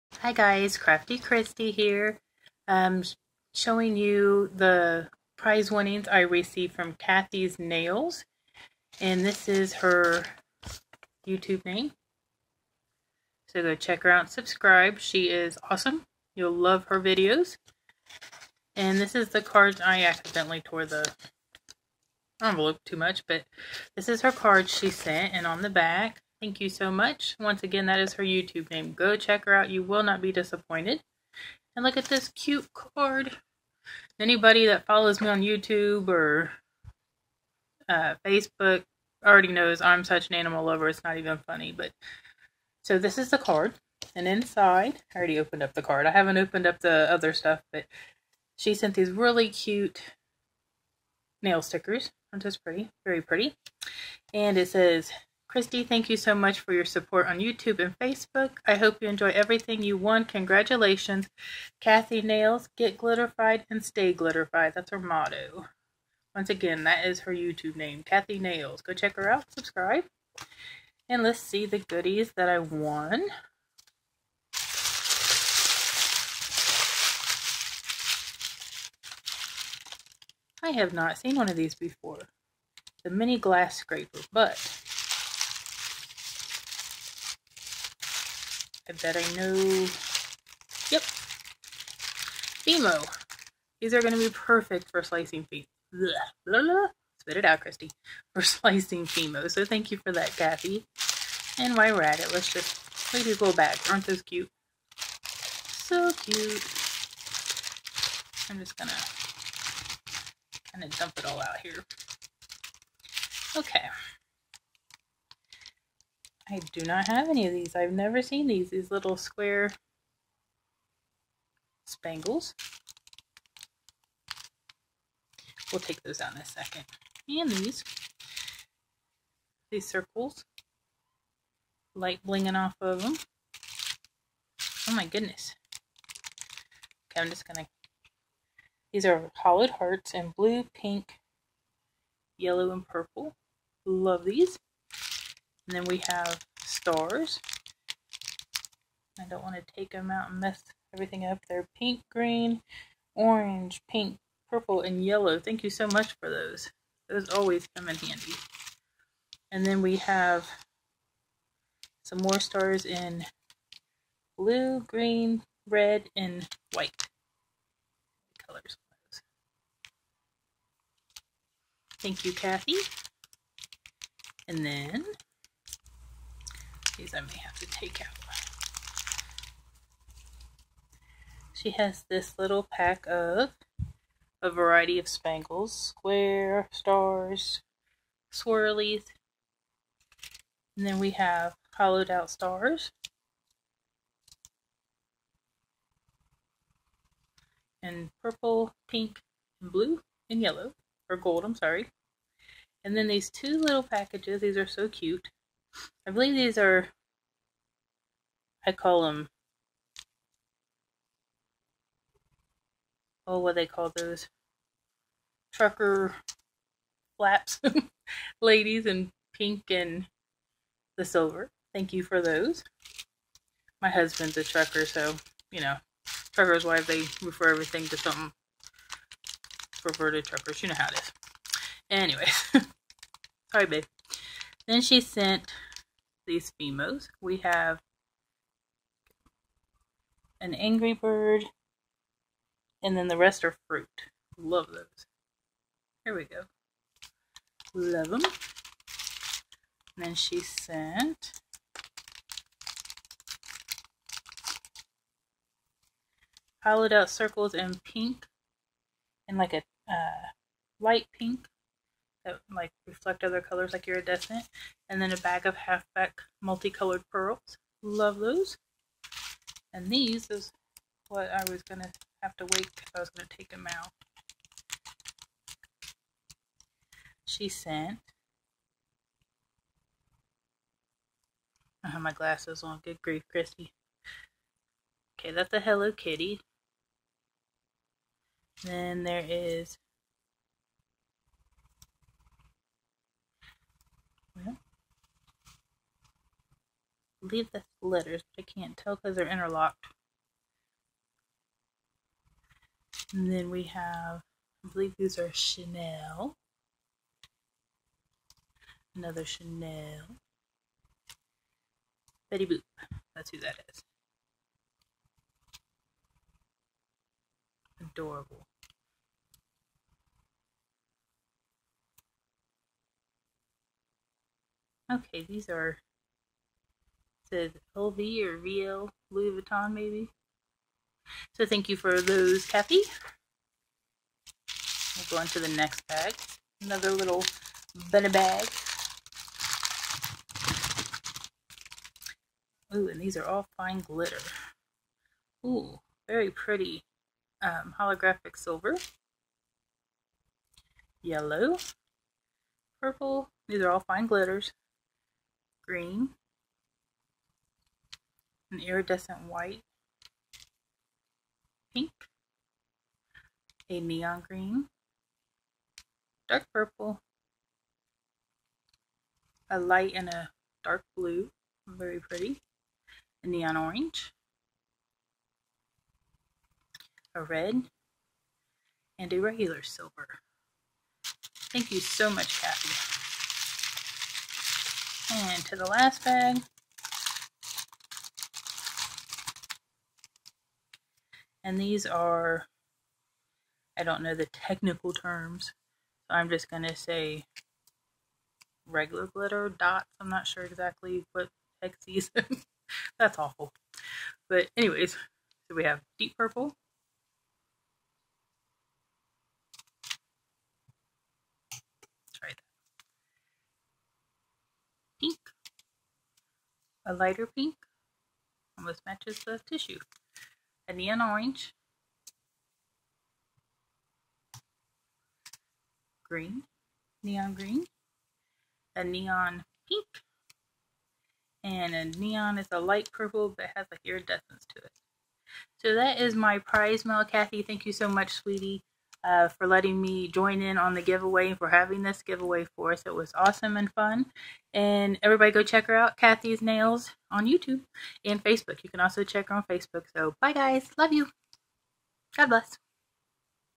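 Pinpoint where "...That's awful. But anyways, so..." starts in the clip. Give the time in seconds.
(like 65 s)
402 s.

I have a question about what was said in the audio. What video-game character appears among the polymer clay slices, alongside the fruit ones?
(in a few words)
Angry Bird.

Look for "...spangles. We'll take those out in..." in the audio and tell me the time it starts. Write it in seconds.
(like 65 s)
121 s.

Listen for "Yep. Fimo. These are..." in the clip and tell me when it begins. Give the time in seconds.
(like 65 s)
90 s.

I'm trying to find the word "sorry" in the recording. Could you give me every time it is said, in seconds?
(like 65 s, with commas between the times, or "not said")
201 s, 233 s.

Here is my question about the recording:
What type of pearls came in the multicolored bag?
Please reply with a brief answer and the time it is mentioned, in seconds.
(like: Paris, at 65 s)
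Halfback, at 265 s.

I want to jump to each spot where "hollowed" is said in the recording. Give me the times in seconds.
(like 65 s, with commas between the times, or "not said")
139 s, 191 s, 256 s.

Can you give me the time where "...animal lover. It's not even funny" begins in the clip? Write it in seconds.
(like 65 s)
40 s.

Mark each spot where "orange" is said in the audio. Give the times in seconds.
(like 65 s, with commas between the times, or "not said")
153 s, 373 s, 420 s.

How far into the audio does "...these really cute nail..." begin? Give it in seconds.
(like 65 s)
48 s.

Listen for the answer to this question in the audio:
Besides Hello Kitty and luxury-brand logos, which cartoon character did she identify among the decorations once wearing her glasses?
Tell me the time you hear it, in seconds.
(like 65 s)
312 s.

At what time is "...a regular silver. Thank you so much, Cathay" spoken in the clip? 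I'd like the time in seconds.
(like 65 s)
379 s.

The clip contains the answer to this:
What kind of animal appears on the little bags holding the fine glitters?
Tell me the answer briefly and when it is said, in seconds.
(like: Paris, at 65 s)
Bunny, at 336 s.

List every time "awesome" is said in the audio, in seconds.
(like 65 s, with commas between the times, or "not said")
15 s, 443 s.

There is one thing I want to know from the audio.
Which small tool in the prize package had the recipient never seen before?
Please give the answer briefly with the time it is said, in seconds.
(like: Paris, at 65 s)
Mini glass scraper, at 83 s.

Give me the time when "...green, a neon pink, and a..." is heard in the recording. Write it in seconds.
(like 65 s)
427 s.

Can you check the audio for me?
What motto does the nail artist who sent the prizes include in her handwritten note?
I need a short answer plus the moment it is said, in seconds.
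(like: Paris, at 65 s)
Get glitterfied and stay glitterfied, at 62 s.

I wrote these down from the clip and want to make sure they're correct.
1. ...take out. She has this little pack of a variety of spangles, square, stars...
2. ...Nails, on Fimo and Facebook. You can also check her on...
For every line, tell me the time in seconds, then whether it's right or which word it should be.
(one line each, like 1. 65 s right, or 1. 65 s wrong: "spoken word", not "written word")
1. 177 s right
2. 446 s wrong: "YouTube", not "Fimo".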